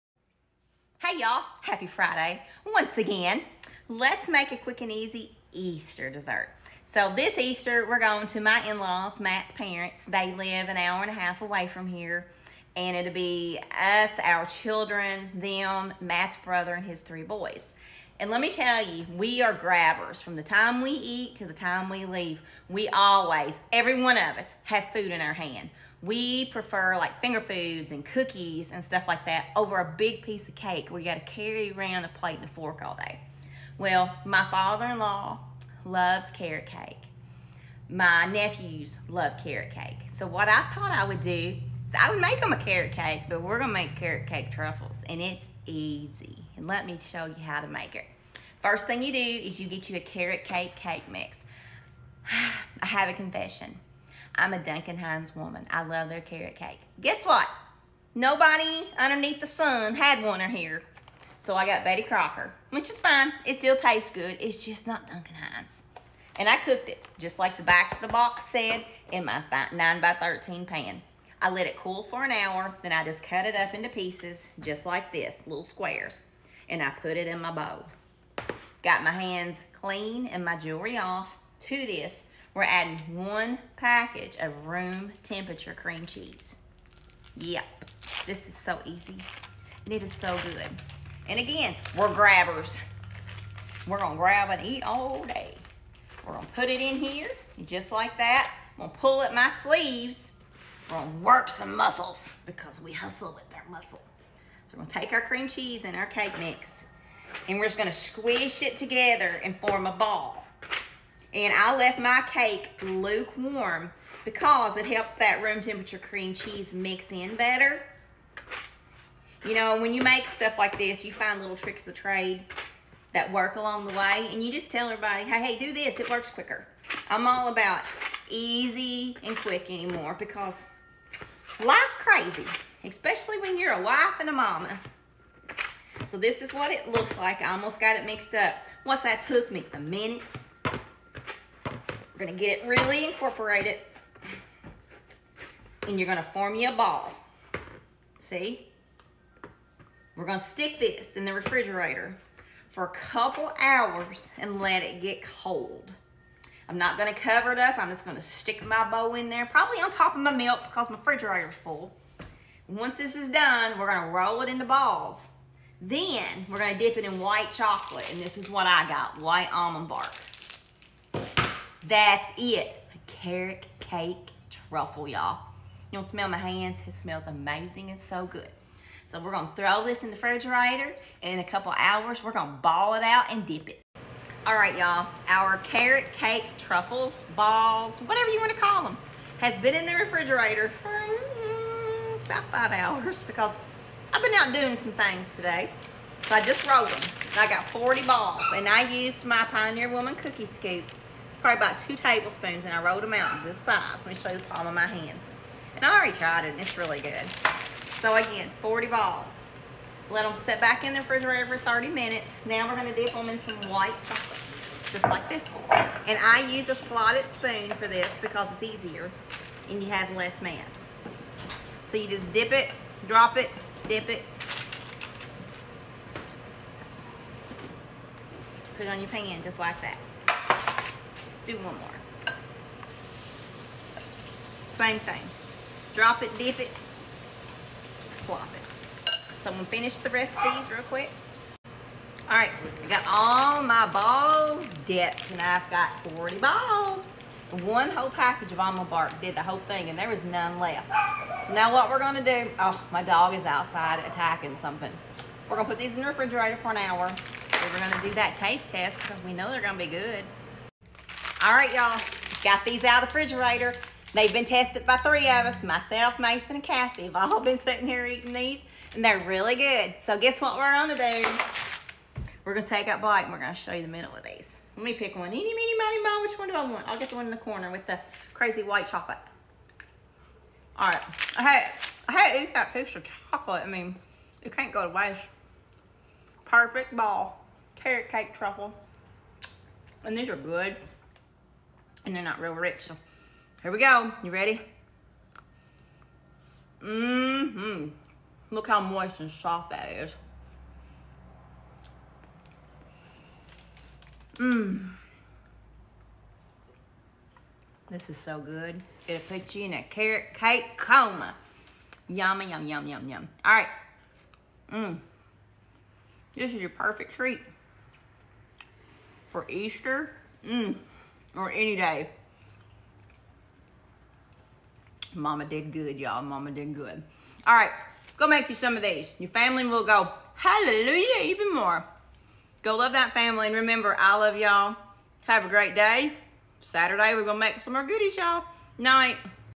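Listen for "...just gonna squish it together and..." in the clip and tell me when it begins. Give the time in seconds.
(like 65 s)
107 s.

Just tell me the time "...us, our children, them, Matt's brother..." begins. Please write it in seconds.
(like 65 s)
13 s.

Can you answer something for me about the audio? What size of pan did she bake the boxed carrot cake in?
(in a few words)
9 by 13.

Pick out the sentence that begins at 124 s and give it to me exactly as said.
And you just tell everybody, hey, hey, do this.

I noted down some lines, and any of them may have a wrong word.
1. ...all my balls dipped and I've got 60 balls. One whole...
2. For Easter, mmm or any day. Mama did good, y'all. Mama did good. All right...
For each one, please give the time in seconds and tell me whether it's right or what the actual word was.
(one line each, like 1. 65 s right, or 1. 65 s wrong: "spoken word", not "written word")
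1. 243 s wrong: "40", not "60"
2. 319 s right.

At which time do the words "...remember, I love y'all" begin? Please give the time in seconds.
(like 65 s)
333 s.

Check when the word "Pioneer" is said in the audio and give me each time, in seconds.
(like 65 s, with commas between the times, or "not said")
199 s.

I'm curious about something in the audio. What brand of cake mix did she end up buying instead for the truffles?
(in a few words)
Betty Crocker.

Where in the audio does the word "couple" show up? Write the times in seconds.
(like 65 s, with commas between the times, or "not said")
152 s, 181 s.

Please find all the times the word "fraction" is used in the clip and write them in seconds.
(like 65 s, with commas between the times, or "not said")
not said.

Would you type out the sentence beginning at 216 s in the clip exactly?
And I use a slotted spoon for this because it's easier and you have less mess.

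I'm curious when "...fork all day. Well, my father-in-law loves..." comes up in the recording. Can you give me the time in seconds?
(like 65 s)
32 s.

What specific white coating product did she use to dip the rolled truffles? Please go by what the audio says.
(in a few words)
white almond bark.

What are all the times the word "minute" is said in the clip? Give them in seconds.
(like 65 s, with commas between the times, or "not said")
139 s, 211 s.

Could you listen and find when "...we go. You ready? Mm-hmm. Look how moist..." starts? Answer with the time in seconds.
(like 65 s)
293 s.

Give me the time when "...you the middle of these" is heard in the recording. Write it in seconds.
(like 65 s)
273 s.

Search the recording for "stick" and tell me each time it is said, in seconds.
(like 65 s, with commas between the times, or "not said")
150 s, 158 s.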